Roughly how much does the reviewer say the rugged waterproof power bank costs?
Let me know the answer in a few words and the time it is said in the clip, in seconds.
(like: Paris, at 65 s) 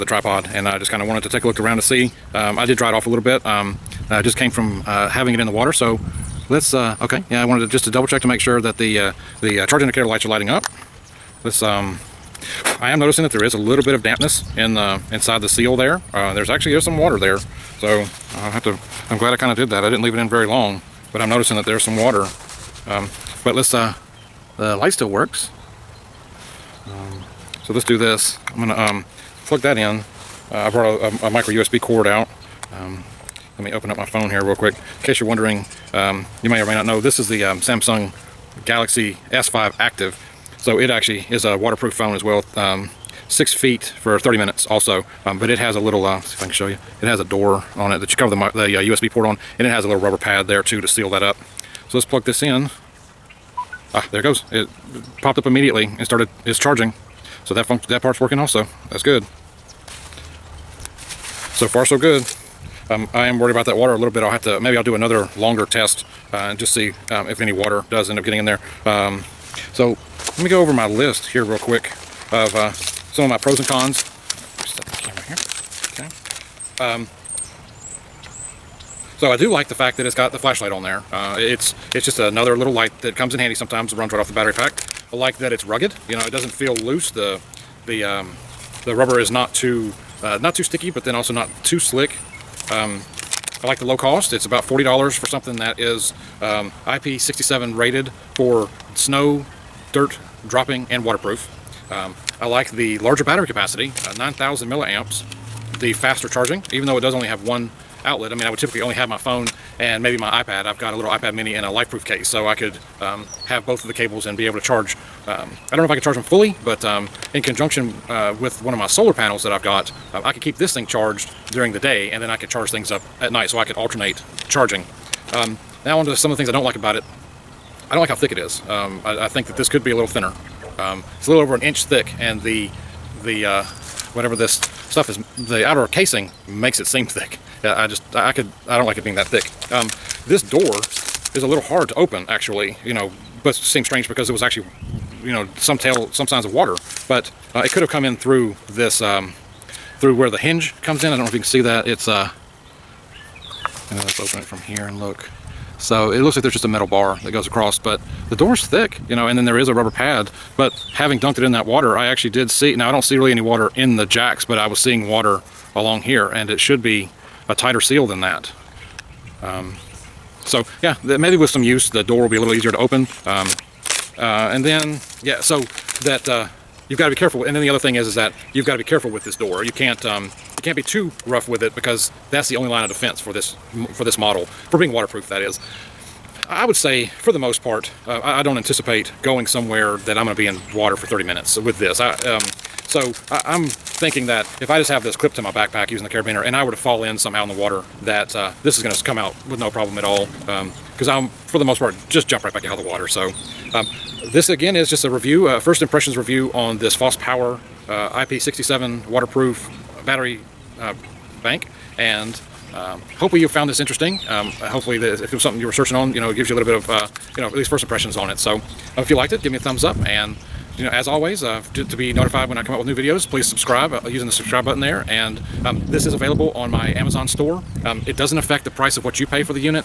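$40, at 94 s.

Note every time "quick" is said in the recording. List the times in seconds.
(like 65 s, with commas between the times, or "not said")
34 s, 71 s.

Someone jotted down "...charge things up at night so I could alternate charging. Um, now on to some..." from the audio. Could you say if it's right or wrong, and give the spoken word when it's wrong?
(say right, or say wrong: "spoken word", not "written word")
right.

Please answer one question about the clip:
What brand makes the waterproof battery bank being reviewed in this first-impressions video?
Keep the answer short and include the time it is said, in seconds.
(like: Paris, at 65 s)
FosPower, at 206 s.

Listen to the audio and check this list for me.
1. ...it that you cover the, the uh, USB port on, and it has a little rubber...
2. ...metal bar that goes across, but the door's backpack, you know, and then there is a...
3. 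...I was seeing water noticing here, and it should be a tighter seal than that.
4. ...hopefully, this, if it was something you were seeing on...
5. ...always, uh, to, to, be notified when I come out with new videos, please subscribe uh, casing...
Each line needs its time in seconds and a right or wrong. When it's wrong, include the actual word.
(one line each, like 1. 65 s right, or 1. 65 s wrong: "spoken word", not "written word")
1. 47 s right
2. 156 s wrong: "thick", not "backpack"
3. 164 s wrong: "along", not "noticing"
4. 214 s wrong: "searching", not "seeing"
5. 221 s wrong: "using", not "casing".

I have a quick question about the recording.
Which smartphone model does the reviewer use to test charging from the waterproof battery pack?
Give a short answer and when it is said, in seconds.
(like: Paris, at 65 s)
Samsung Galaxy S5 Active, at 37 s.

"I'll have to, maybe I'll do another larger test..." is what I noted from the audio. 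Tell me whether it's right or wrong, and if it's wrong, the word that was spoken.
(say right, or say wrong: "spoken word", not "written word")
wrong: "longer", not "larger".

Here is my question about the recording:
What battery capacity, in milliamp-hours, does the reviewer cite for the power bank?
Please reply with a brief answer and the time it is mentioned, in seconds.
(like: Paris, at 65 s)
9,000, at 104 s.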